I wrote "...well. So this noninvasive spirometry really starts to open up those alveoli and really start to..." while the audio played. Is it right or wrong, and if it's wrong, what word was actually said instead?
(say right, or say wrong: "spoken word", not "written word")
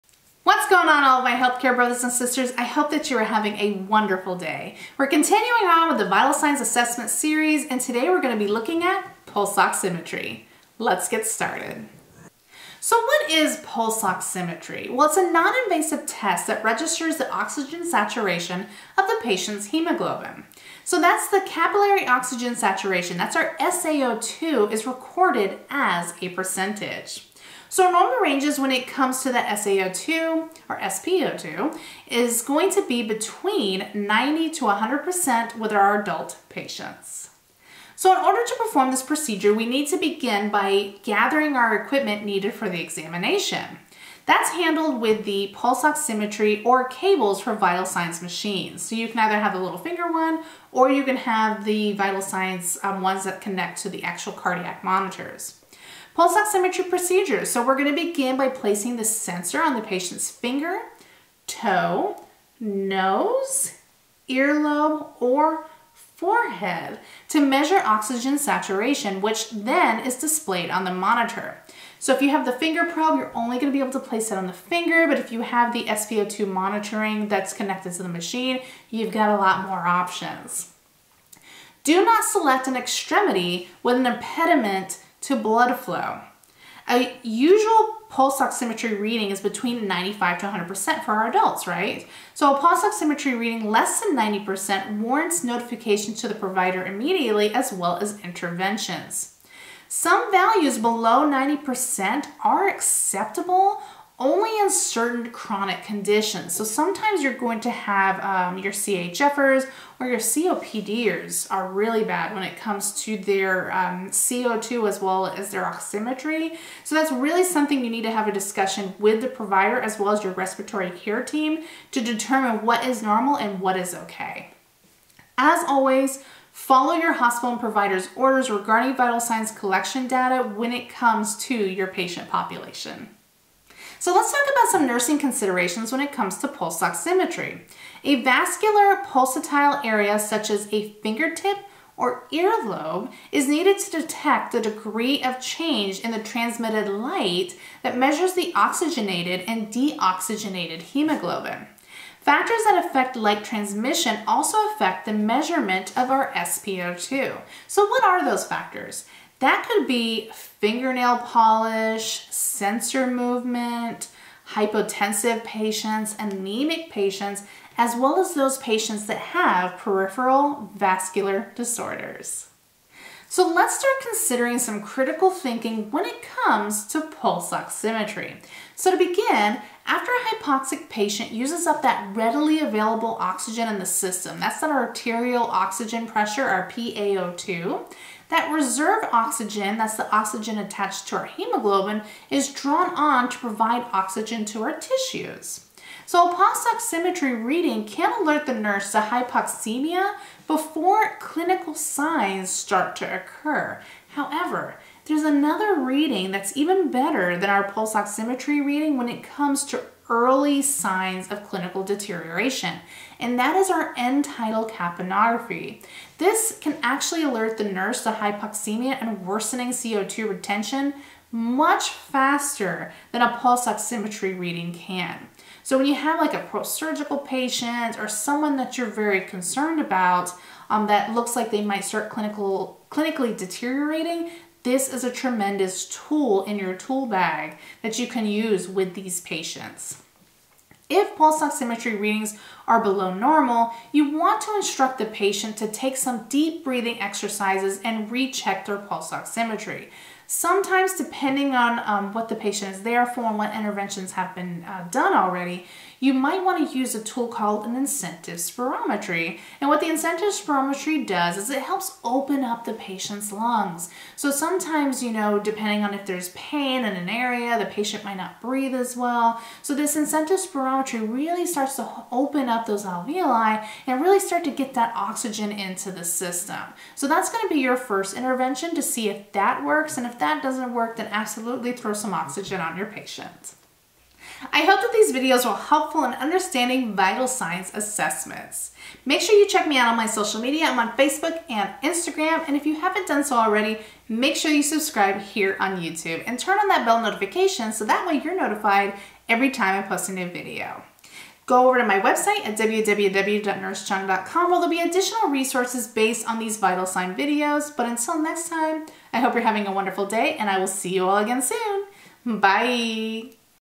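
wrong: "incentive", not "noninvasive".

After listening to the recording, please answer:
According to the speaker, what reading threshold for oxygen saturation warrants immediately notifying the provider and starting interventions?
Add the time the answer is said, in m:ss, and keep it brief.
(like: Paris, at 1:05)
less than 90%, at 1:33.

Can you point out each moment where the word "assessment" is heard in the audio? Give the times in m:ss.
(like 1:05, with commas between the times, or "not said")
0:06, 4:47.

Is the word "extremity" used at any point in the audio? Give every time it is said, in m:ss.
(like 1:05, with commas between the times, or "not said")
1:22.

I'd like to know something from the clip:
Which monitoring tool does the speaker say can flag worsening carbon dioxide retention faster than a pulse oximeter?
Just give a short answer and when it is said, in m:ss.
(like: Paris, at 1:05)
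end tidal capnography, at 3:33.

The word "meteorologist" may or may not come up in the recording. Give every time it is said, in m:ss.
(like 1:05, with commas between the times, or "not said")
not said.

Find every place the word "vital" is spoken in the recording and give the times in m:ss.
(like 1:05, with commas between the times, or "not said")
0:06, 0:47, 0:51, 2:08, 4:46, 5:06.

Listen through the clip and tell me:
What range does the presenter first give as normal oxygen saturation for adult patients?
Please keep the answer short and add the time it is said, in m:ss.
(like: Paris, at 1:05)
90 to 100%, at 0:33.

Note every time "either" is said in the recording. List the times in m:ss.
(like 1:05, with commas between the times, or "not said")
0:49.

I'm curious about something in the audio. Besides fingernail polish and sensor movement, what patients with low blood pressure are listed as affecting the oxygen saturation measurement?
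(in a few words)
hypotensive patients.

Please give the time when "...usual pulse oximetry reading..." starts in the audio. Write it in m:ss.
1:27.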